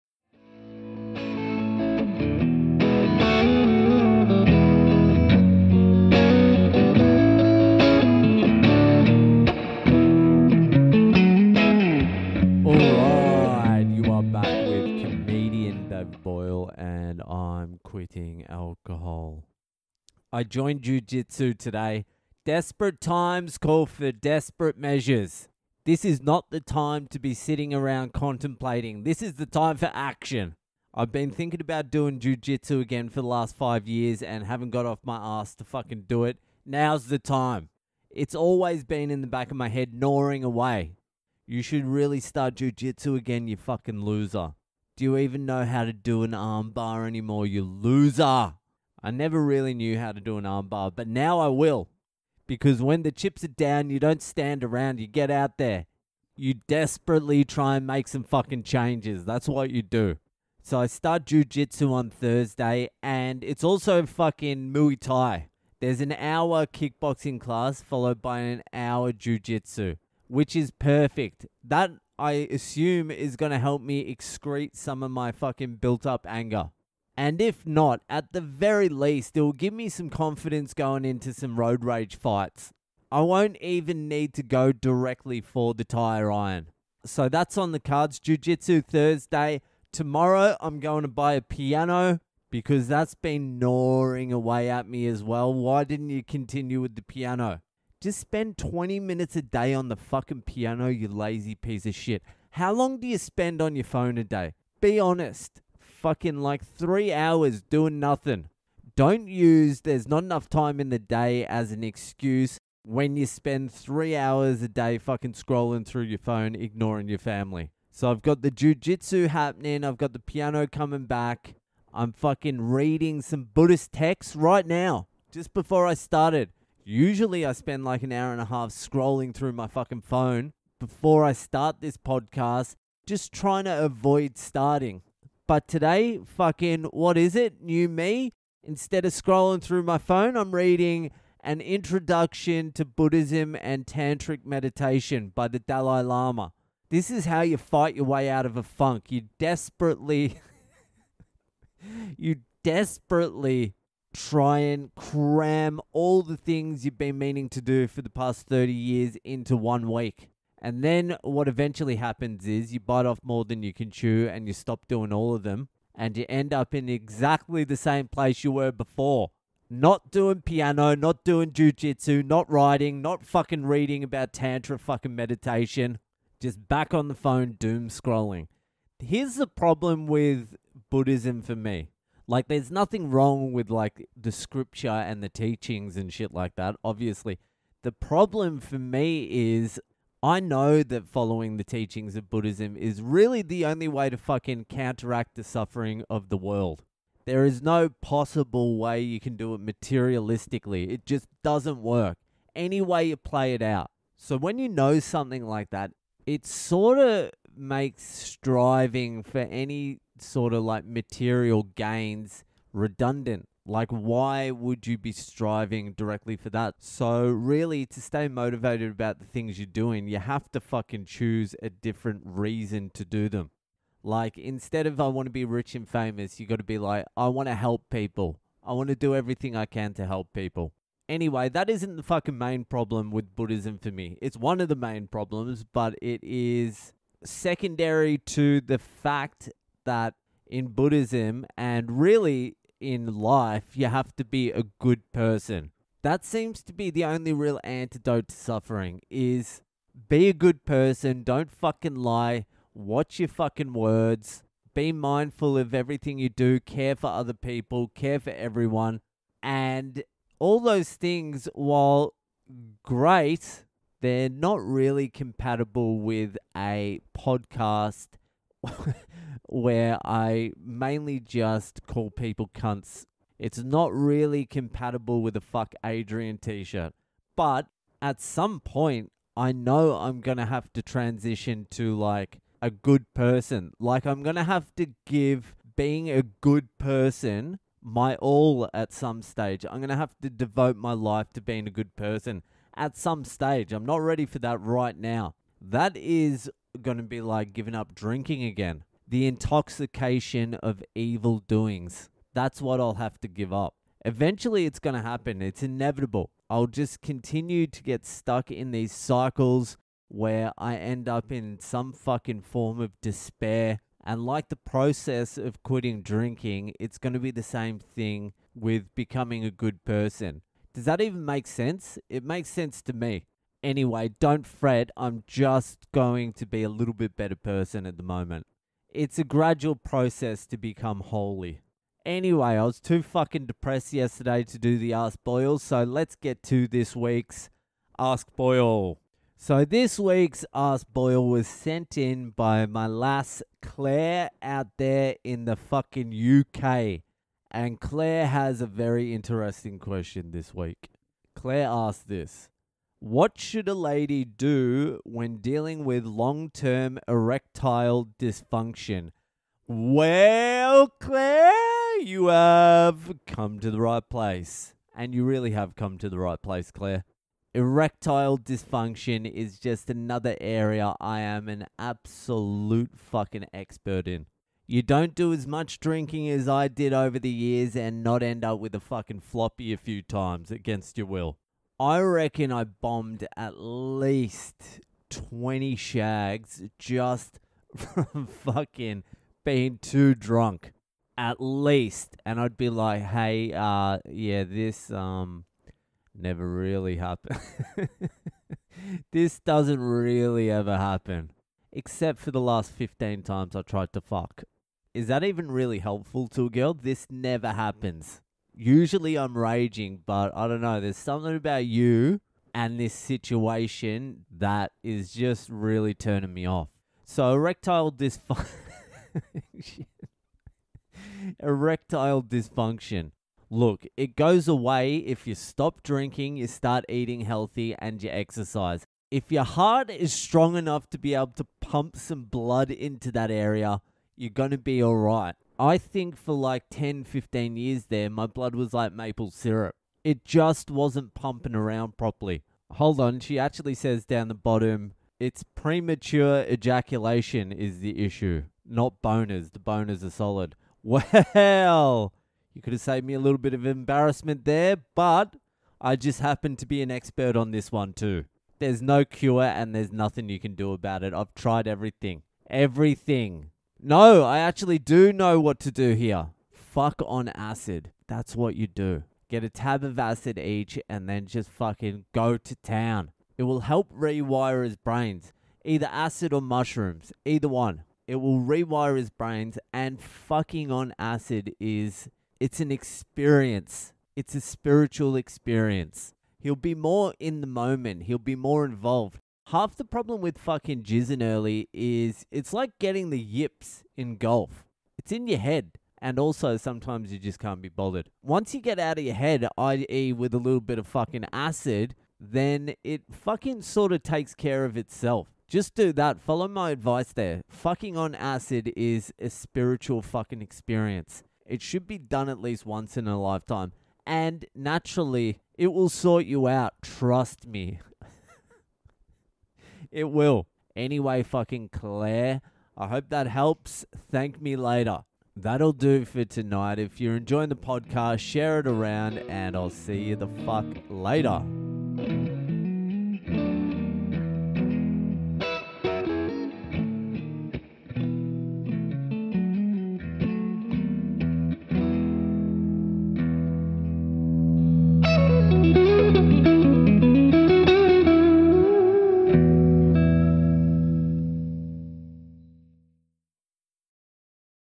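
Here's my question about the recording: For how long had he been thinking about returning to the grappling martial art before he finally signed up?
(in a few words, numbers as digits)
5 years.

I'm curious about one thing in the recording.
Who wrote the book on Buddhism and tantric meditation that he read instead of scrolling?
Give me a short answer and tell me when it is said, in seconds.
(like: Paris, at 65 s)
The Dalai Lama, at 145 s.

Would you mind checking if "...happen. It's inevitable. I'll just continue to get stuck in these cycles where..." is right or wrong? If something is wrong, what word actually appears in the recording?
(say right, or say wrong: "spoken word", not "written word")
right.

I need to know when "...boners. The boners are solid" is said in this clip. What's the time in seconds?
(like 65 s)
449 s.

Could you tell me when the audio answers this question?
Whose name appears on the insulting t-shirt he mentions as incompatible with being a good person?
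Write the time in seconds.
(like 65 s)
275 s.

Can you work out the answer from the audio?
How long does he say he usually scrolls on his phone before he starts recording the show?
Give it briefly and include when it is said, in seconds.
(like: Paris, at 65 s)
An hour and a half, at 128 s.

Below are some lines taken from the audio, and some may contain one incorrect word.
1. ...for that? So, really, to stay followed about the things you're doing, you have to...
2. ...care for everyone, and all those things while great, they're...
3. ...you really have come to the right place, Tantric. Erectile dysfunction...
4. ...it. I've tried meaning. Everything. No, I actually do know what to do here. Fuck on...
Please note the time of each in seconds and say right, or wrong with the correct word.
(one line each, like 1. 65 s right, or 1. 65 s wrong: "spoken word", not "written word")
1. 216 s wrong: "motivated", not "followed"
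2. 257 s right
3. 365 s wrong: "Claire", not "Tantric"
4. 461 s wrong: "everything", not "meaning".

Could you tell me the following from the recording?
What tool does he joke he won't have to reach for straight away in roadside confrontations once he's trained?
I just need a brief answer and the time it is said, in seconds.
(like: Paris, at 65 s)
Tire iron, at 85 s.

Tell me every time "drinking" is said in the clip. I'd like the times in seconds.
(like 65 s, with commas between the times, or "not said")
297 s, 316 s, 375 s, 425 s.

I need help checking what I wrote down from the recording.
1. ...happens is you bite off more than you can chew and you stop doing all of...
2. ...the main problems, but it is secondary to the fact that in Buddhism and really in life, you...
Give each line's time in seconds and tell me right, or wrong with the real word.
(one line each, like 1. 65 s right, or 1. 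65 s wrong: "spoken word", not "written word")
1. 161 s right
2. 234 s right.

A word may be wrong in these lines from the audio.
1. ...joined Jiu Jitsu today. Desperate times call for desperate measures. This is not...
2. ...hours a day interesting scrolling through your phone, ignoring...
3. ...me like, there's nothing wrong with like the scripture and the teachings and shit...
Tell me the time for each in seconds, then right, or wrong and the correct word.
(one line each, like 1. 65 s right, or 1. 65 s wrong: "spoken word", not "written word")
1. 20 s right
2. 114 s wrong: "fucking", not "interesting"
3. 181 s right.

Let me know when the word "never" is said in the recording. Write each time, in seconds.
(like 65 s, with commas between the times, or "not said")
49 s, 396 s, 407 s.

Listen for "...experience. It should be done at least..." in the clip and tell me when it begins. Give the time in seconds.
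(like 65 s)
510 s.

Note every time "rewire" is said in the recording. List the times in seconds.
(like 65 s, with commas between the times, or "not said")
473 s, 478 s.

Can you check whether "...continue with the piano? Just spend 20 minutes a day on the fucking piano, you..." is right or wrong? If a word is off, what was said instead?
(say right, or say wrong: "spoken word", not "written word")
right.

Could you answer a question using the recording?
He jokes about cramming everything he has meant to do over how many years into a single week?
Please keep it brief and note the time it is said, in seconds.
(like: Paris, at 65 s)
30 years, at 158 s.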